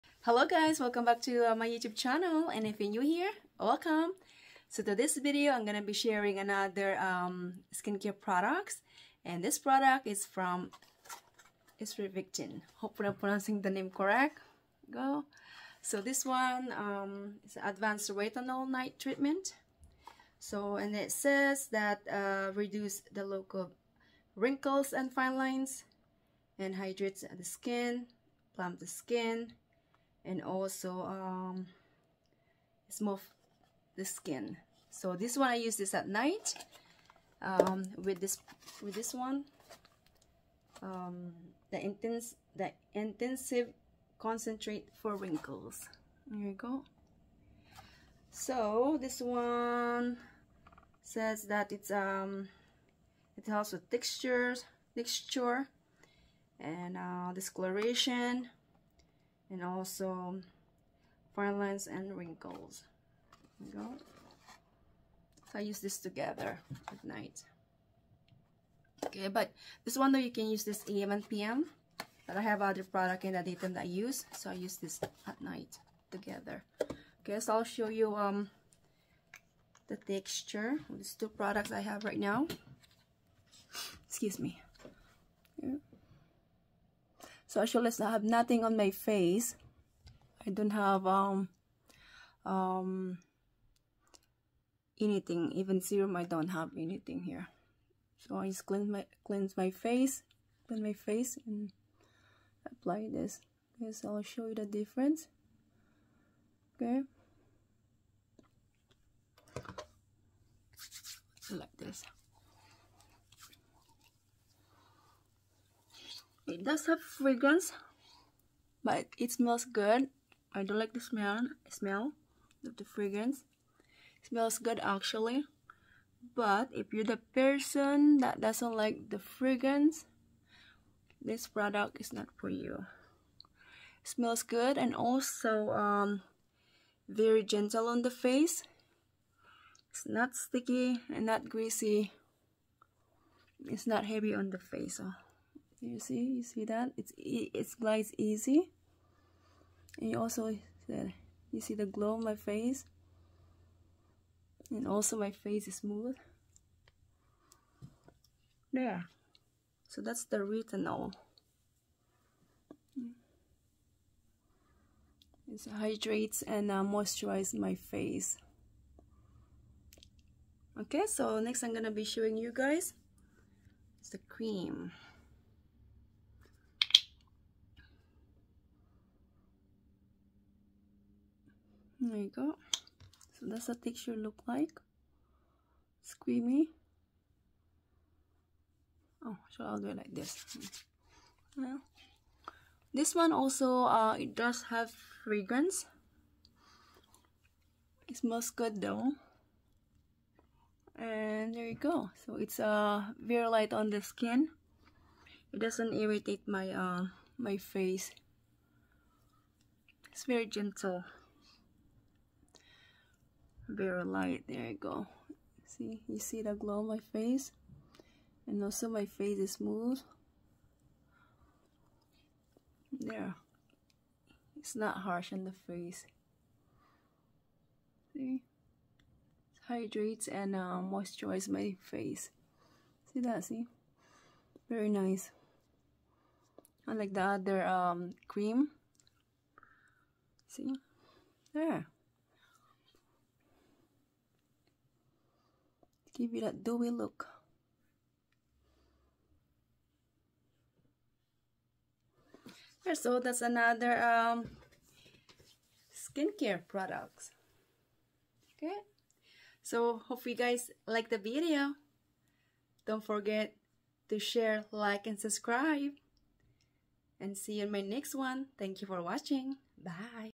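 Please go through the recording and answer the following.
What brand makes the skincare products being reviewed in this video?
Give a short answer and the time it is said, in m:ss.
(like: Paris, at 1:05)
StriVectin, at 0:11.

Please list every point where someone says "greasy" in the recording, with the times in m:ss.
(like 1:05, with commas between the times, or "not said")
2:21.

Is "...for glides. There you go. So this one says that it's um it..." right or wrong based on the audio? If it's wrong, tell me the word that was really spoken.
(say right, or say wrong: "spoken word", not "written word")
wrong: "wrinkles", not "glides".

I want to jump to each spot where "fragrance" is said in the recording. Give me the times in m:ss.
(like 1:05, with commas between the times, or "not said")
1:56, 2:02, 2:09, 3:15.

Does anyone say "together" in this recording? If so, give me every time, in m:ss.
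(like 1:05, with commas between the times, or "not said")
1:05, 1:16.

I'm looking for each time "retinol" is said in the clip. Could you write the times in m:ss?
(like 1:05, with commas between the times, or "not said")
0:18, 2:40.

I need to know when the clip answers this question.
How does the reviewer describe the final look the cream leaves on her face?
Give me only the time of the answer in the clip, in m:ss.
4:06.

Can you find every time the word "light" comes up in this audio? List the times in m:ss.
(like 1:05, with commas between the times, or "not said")
3:23, 3:34.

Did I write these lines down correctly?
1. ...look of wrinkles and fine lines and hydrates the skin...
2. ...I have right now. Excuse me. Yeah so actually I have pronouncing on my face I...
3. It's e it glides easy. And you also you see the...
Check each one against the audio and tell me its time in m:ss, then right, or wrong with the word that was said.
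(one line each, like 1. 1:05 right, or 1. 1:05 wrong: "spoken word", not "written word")
1. 0:23 right
2. 1:21 wrong: "nothing", not "pronouncing"
3. 2:26 right.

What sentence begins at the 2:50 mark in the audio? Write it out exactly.
Okay, so next I'm gonna be showing you guys it's the cream.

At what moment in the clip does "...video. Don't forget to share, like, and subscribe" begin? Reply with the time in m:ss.
4:21.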